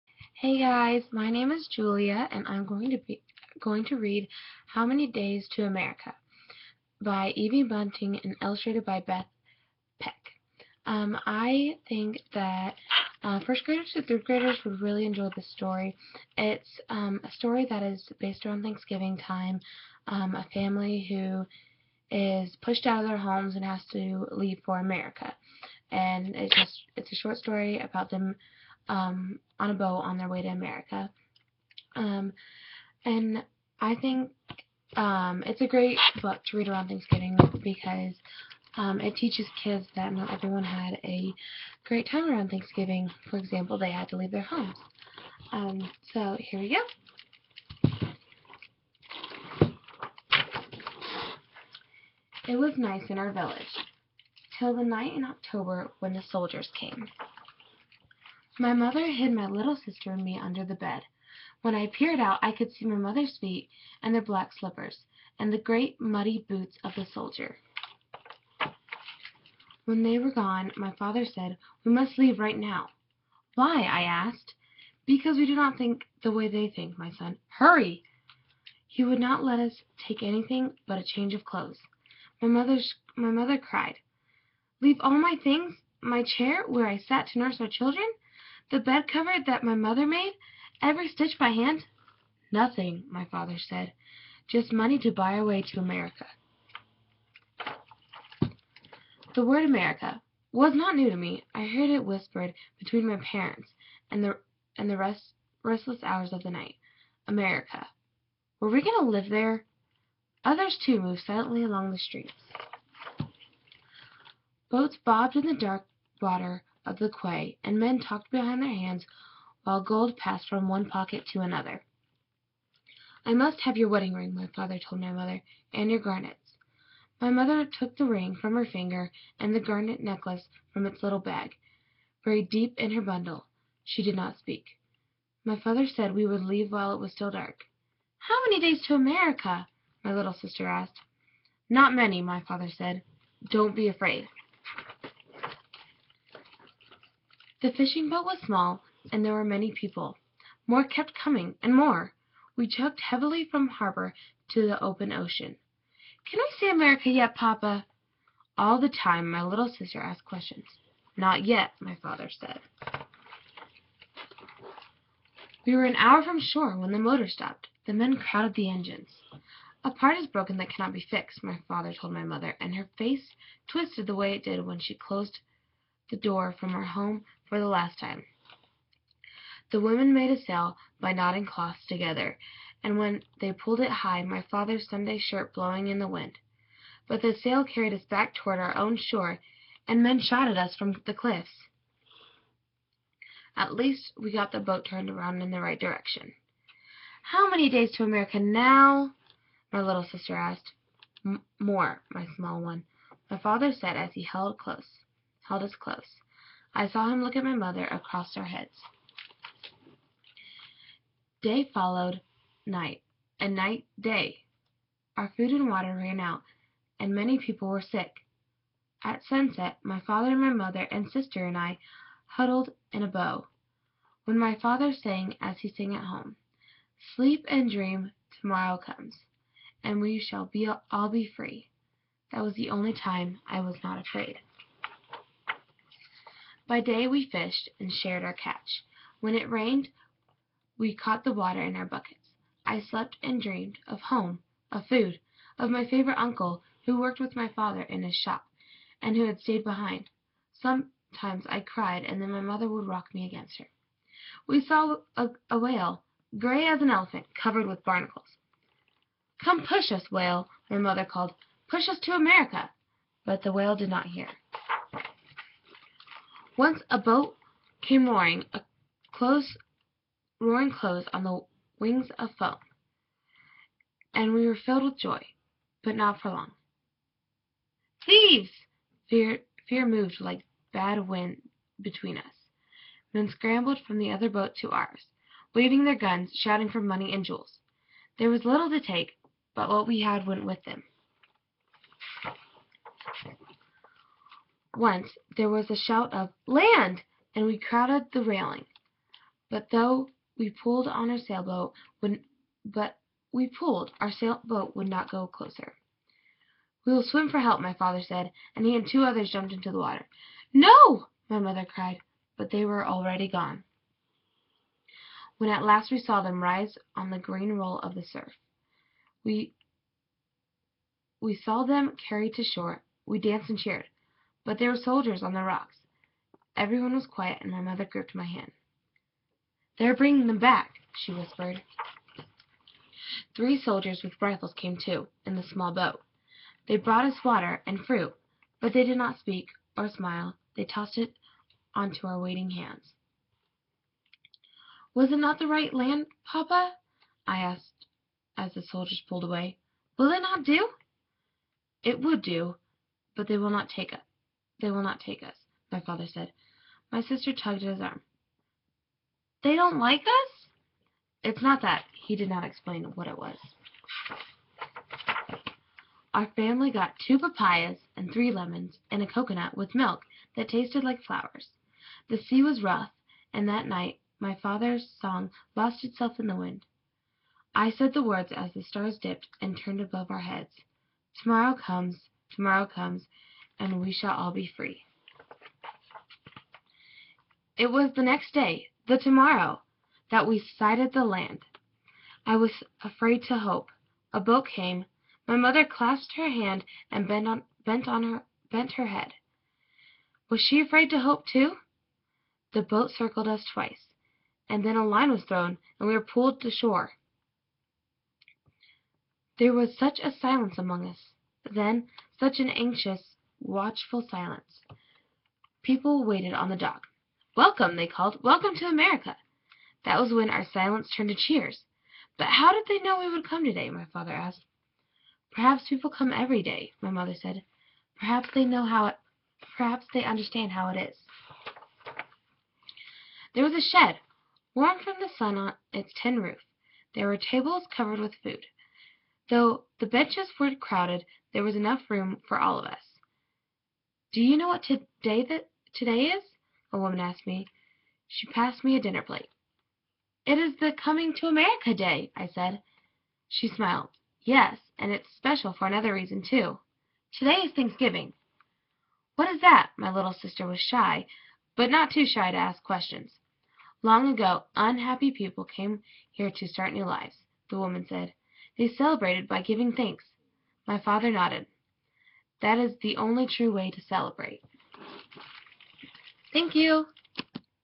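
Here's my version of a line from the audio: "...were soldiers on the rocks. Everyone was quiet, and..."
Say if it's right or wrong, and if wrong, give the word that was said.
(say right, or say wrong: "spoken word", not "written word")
right.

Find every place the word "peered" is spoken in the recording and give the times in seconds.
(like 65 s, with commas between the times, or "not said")
61 s.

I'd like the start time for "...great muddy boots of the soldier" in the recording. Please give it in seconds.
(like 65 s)
65 s.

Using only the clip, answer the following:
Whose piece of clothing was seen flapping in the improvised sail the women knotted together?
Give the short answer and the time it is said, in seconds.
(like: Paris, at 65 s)
father's Sunday shirt, at 184 s.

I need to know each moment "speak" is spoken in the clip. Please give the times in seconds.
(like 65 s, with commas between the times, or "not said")
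134 s, 339 s.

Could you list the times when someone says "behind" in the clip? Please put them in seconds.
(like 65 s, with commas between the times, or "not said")
118 s, 249 s.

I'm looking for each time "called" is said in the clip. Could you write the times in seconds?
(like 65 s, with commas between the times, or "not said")
261 s, 417 s.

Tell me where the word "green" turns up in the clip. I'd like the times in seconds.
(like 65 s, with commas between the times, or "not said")
317 s.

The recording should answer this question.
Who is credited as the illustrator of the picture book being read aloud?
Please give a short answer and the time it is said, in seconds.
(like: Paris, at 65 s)
Beth Peck, at 9 s.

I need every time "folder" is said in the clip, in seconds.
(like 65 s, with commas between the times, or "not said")
not said.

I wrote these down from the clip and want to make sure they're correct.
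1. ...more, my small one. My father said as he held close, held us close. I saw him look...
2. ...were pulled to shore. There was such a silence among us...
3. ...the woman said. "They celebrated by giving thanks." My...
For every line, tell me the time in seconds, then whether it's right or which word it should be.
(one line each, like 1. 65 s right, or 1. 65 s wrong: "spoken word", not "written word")
1. 201 s right
2. 405 s right
3. 467 s right.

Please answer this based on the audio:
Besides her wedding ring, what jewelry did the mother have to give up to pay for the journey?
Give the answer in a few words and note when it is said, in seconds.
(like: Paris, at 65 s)
garnets, at 125 s.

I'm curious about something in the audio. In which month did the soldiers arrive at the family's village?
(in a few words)
October.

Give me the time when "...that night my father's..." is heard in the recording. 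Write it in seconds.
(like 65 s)
373 s.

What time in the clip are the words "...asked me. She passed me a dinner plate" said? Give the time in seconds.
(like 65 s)
446 s.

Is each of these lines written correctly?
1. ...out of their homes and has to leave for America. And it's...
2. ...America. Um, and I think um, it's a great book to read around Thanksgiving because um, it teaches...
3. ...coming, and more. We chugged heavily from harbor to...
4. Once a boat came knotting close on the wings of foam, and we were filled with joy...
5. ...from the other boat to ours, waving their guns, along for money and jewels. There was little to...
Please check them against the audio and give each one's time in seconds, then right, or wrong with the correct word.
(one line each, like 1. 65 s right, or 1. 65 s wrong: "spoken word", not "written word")
1. 22 s right
2. 30 s right
3. 151 s right
4. 266 s wrong: "roaring", not "knotting"
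5. 283 s wrong: "shouting", not "along".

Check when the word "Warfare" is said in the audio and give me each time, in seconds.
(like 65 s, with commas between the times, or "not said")
not said.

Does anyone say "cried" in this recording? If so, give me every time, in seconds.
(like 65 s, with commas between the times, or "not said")
83 s, 251 s, 311 s.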